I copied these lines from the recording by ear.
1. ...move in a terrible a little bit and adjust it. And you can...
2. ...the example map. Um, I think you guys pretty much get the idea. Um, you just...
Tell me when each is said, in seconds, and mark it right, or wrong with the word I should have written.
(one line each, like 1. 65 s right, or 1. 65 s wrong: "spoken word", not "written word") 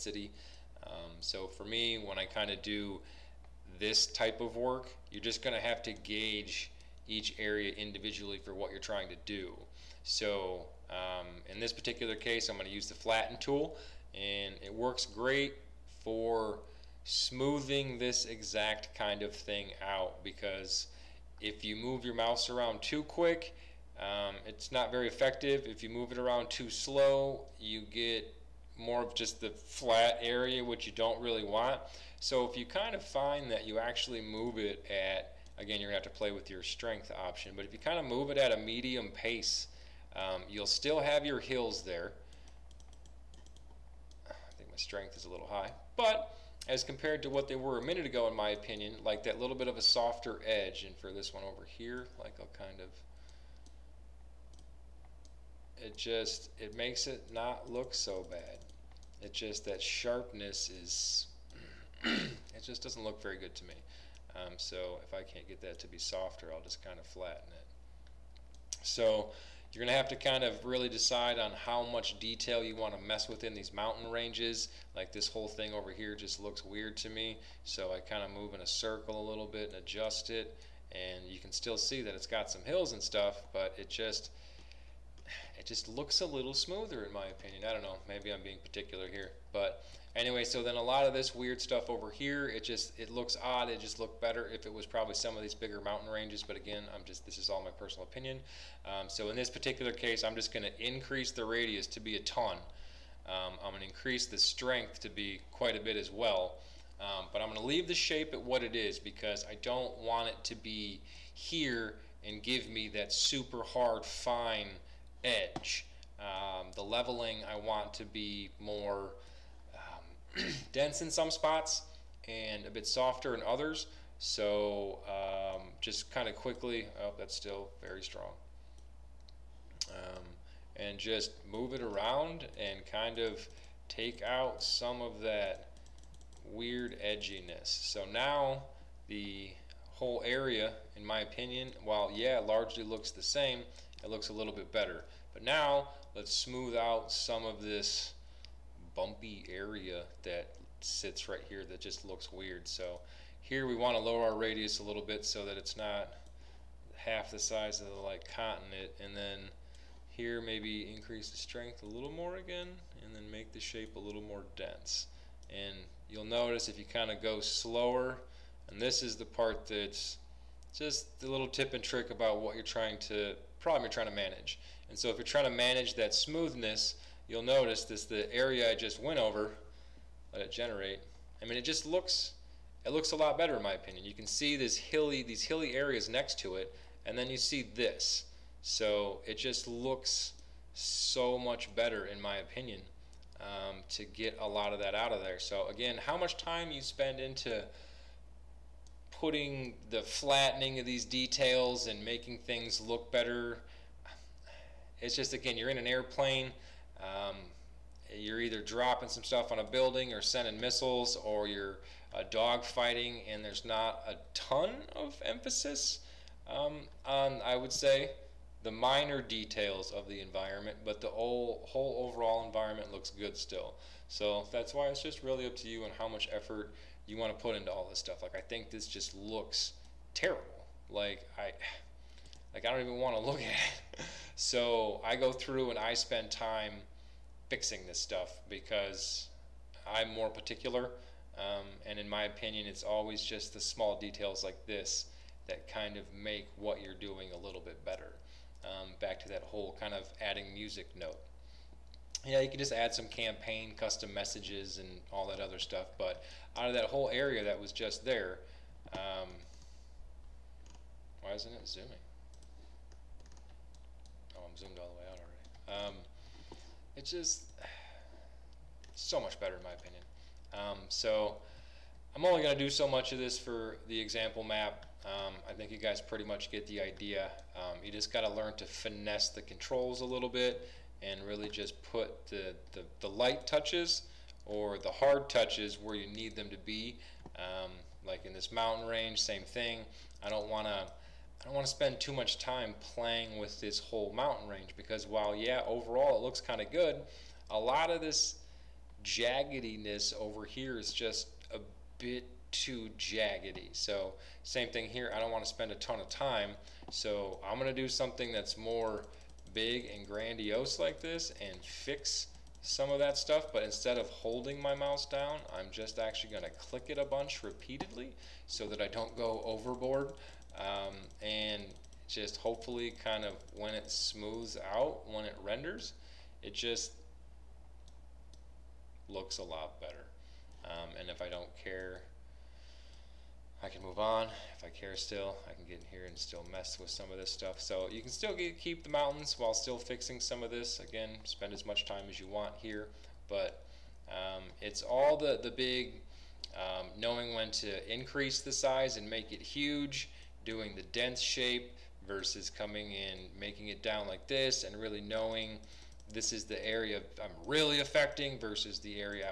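1. 78 s wrong: "circle", not "terrible"
2. 273 s right.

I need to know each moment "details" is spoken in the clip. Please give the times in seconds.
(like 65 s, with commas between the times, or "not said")
72 s, 201 s, 219 s, 243 s.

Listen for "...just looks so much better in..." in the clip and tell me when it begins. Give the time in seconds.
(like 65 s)
189 s.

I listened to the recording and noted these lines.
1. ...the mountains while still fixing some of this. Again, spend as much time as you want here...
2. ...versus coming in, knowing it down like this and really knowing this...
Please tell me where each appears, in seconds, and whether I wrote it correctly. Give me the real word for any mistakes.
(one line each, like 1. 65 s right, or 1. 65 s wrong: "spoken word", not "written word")
1. 338 s right
2. 352 s wrong: "making", not "knowing".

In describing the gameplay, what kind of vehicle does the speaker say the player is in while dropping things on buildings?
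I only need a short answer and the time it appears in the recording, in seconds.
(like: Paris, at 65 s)
an airplane, at 205 s.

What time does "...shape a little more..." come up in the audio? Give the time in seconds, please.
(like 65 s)
163 s.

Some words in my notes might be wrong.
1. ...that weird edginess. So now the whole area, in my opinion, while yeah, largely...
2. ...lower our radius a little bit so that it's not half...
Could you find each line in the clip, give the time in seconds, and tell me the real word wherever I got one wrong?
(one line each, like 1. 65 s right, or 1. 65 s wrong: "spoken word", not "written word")
1. 135 s right
2. 154 s right.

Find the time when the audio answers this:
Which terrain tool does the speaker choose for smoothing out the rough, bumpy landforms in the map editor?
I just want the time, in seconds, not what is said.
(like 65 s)
12 s.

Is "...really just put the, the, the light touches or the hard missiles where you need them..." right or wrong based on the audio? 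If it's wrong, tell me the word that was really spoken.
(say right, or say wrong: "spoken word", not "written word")
wrong: "touches", not "missiles".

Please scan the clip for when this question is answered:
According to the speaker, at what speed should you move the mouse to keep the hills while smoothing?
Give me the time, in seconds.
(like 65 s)
38 s.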